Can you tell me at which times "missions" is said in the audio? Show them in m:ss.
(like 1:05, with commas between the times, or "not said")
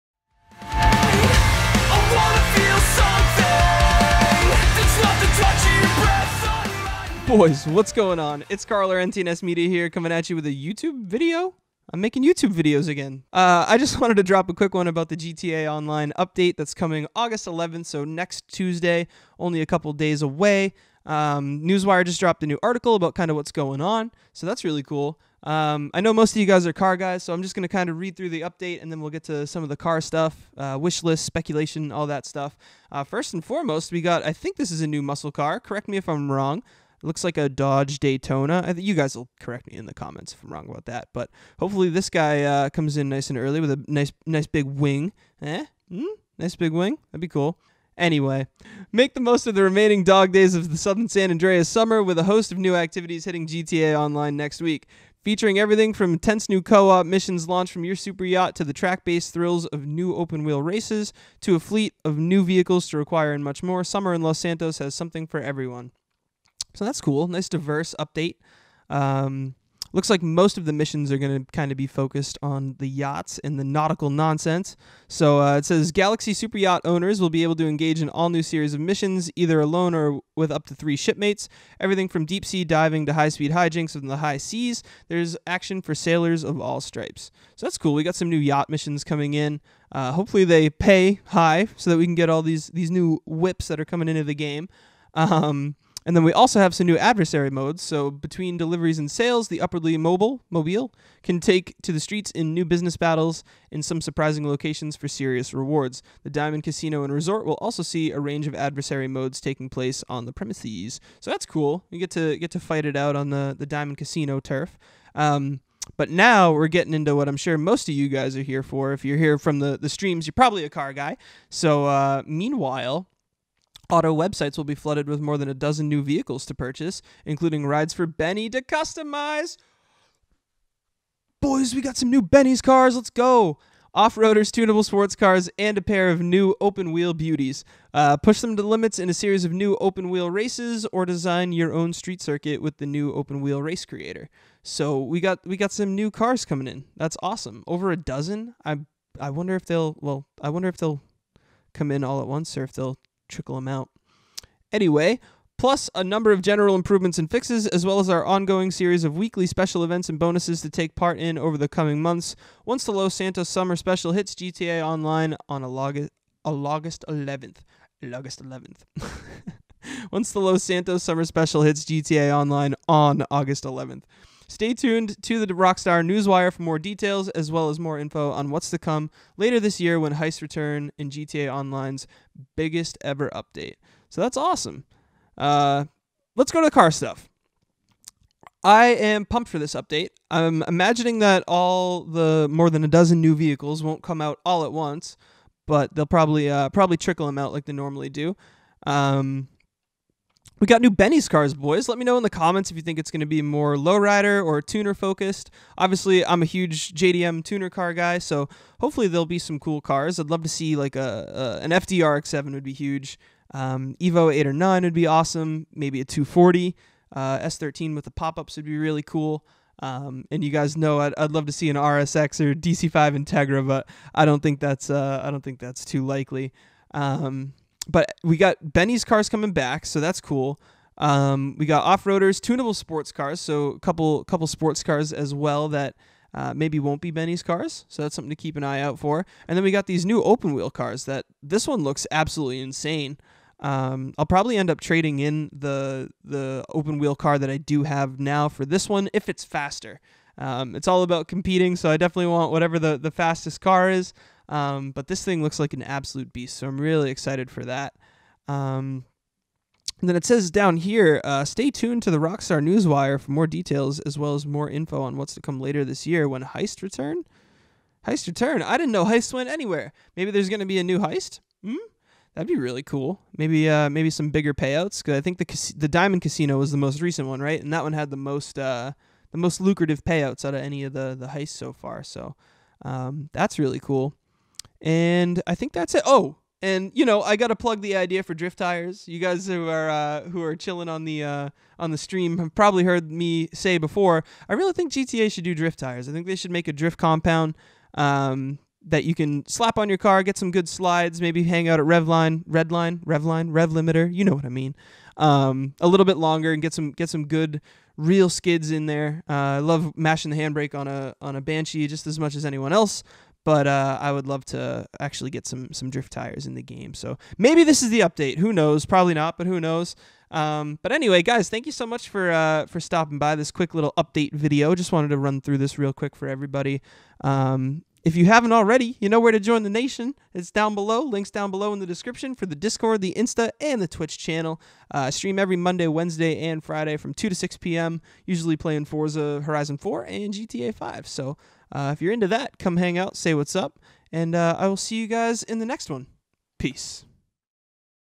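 0:57, 1:10, 1:18, 1:28.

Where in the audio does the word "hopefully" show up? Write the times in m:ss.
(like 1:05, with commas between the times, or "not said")
0:41, 1:30, 3:28.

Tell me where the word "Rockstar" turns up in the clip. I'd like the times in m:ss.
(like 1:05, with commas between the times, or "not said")
2:55, 4:22.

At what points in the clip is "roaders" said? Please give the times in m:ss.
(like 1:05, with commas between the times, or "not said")
2:14, 3:51.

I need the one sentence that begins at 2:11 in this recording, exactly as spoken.
Boys, we got some new Benny's cars.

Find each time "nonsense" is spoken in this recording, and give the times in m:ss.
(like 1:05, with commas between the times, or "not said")
1:14.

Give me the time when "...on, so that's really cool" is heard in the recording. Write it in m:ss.
0:23.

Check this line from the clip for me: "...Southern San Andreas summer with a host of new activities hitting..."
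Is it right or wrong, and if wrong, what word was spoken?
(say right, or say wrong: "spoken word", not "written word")
right.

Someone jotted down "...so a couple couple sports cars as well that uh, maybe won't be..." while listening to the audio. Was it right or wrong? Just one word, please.
right.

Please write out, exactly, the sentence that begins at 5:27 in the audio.
Um, if you haven't already, you know where to join the nation.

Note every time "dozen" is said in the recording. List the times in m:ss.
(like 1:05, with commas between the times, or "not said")
2:05, 2:27, 3:12.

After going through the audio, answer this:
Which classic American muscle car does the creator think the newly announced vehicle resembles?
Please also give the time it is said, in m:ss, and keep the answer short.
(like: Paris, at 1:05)
Dodge Daytona, at 0:37.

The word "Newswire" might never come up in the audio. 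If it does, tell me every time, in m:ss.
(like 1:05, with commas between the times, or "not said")
0:21, 2:56, 4:22.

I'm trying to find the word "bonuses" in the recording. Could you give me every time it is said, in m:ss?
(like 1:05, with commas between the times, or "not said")
2:40.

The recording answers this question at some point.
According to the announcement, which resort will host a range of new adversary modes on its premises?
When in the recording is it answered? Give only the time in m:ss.
1:46.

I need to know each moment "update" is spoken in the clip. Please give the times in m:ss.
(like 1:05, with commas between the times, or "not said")
0:16, 0:28, 1:07, 3:03, 3:09, 5:18, 5:23.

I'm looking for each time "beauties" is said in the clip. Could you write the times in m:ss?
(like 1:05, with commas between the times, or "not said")
2:17.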